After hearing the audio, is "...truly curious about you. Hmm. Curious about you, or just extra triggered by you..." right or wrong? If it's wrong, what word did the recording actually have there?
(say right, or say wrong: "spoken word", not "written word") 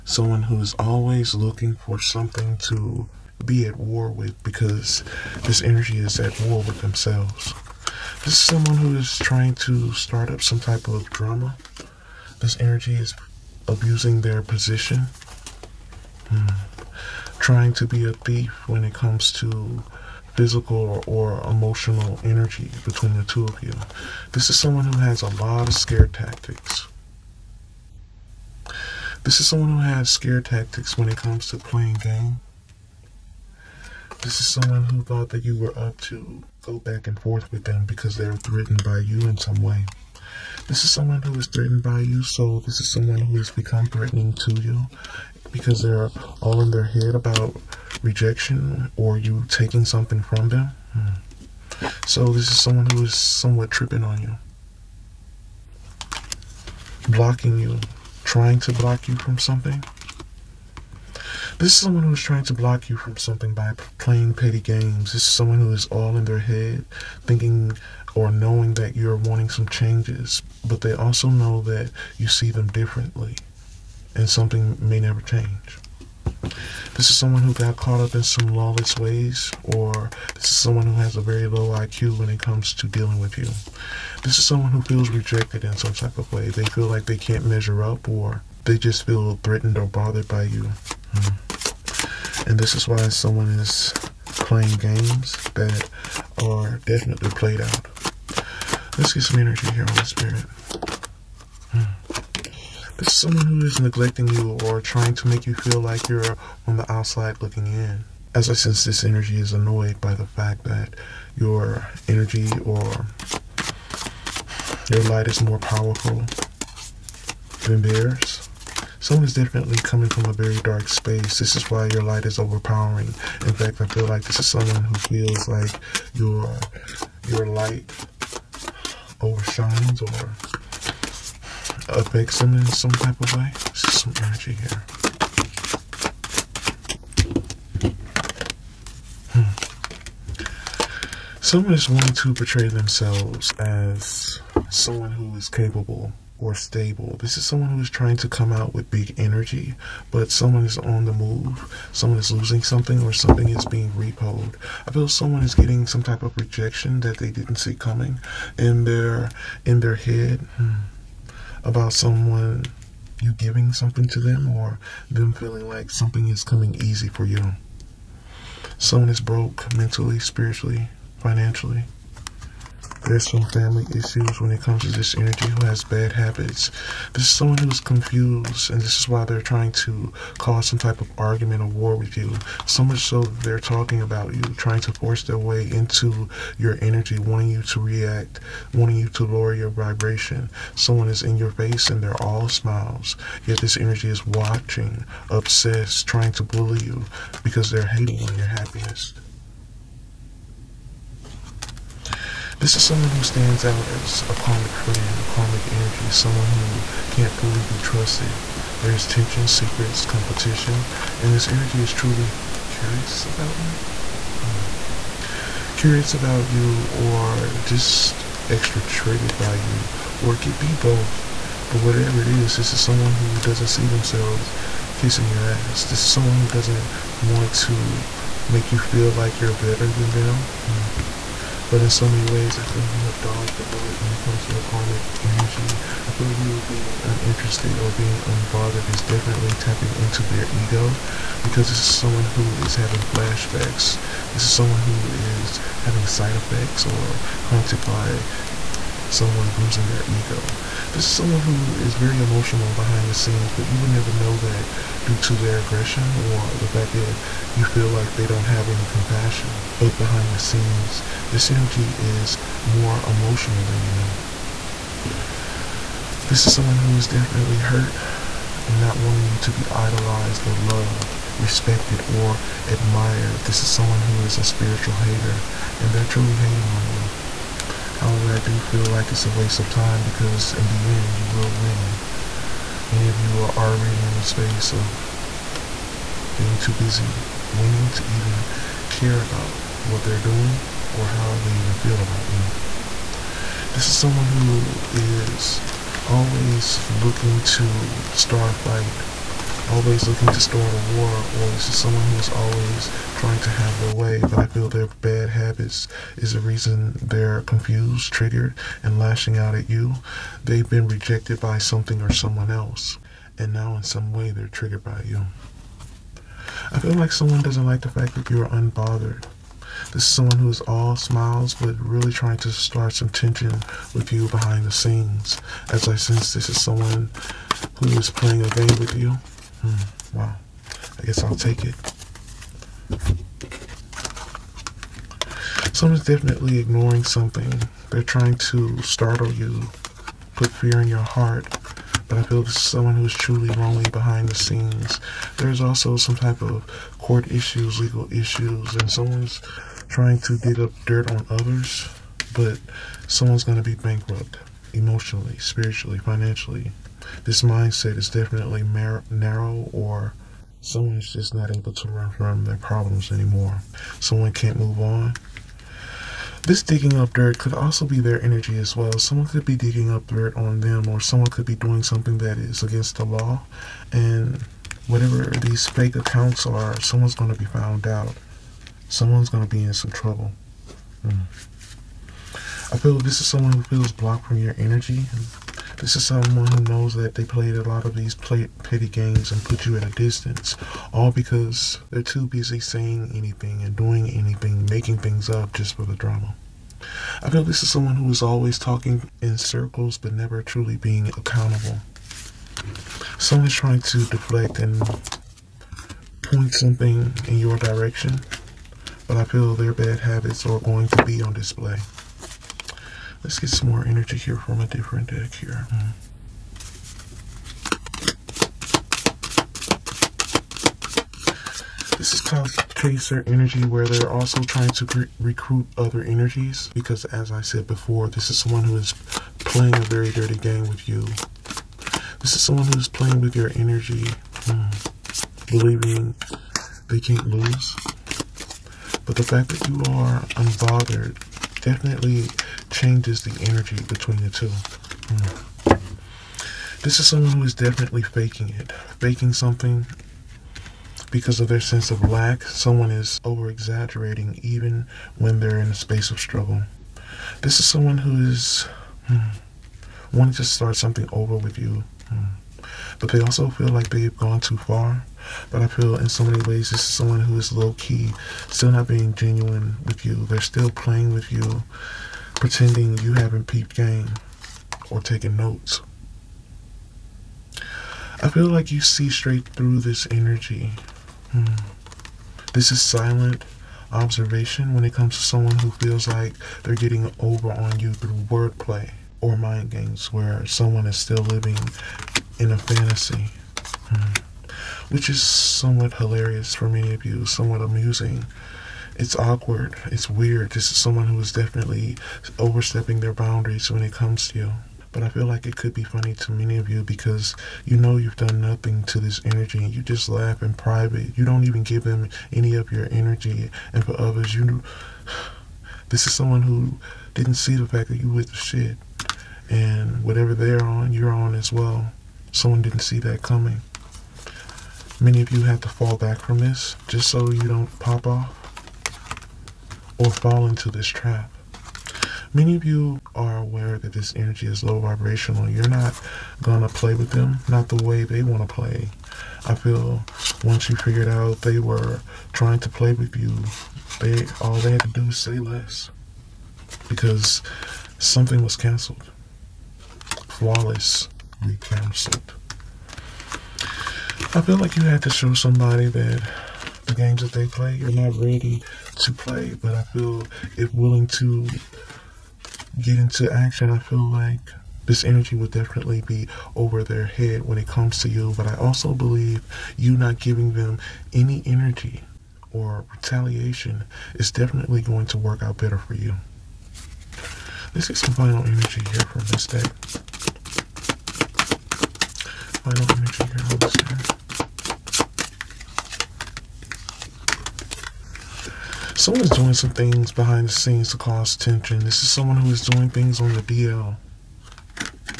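right.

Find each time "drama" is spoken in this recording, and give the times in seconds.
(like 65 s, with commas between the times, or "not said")
11 s, 395 s.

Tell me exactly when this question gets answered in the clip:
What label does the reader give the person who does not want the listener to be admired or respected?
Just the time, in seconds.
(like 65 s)
274 s.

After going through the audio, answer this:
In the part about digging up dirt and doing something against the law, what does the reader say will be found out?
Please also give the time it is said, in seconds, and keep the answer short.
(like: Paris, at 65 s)
Fake accounts, at 375 s.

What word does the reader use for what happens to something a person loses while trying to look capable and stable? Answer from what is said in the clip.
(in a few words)
Repoed.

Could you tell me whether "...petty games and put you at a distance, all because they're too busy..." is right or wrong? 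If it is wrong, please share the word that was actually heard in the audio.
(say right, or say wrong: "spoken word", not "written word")
right.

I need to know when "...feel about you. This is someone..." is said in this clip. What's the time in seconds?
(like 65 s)
291 s.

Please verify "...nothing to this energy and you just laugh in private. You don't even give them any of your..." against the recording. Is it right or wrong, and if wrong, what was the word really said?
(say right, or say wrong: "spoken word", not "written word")
right.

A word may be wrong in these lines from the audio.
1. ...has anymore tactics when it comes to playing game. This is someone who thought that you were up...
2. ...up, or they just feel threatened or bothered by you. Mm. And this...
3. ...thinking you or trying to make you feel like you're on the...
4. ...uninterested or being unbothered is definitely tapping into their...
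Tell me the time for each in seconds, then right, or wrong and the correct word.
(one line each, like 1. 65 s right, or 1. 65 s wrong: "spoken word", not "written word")
1. 29 s wrong: "scare", not "anymore"
2. 87 s right
3. 103 s wrong: "neglecting", not "thinking"
4. 237 s right.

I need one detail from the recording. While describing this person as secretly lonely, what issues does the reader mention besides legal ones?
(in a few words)
Court issues.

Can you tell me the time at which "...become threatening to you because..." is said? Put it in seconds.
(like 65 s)
43 s.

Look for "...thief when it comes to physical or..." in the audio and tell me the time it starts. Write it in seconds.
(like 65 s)
18 s.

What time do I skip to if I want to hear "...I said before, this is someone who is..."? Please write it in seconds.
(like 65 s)
427 s.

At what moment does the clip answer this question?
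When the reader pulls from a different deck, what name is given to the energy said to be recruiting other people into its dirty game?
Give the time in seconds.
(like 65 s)
422 s.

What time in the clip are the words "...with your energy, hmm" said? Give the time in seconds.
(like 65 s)
433 s.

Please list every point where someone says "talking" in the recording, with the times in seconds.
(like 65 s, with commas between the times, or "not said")
183 s, 398 s.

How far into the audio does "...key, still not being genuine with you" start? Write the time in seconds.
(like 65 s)
467 s.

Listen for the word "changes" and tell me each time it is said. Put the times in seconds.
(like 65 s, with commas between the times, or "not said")
69 s, 75 s, 442 s.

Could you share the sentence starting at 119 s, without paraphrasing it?
Someone is definitely coming from a very dark space.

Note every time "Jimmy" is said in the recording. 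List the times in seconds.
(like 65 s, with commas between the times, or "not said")
not said.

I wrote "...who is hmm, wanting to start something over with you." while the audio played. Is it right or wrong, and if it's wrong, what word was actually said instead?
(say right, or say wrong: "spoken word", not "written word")
right.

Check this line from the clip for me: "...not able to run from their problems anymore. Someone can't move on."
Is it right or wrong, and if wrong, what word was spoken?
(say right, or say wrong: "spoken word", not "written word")
right.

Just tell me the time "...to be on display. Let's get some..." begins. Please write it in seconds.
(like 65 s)
410 s.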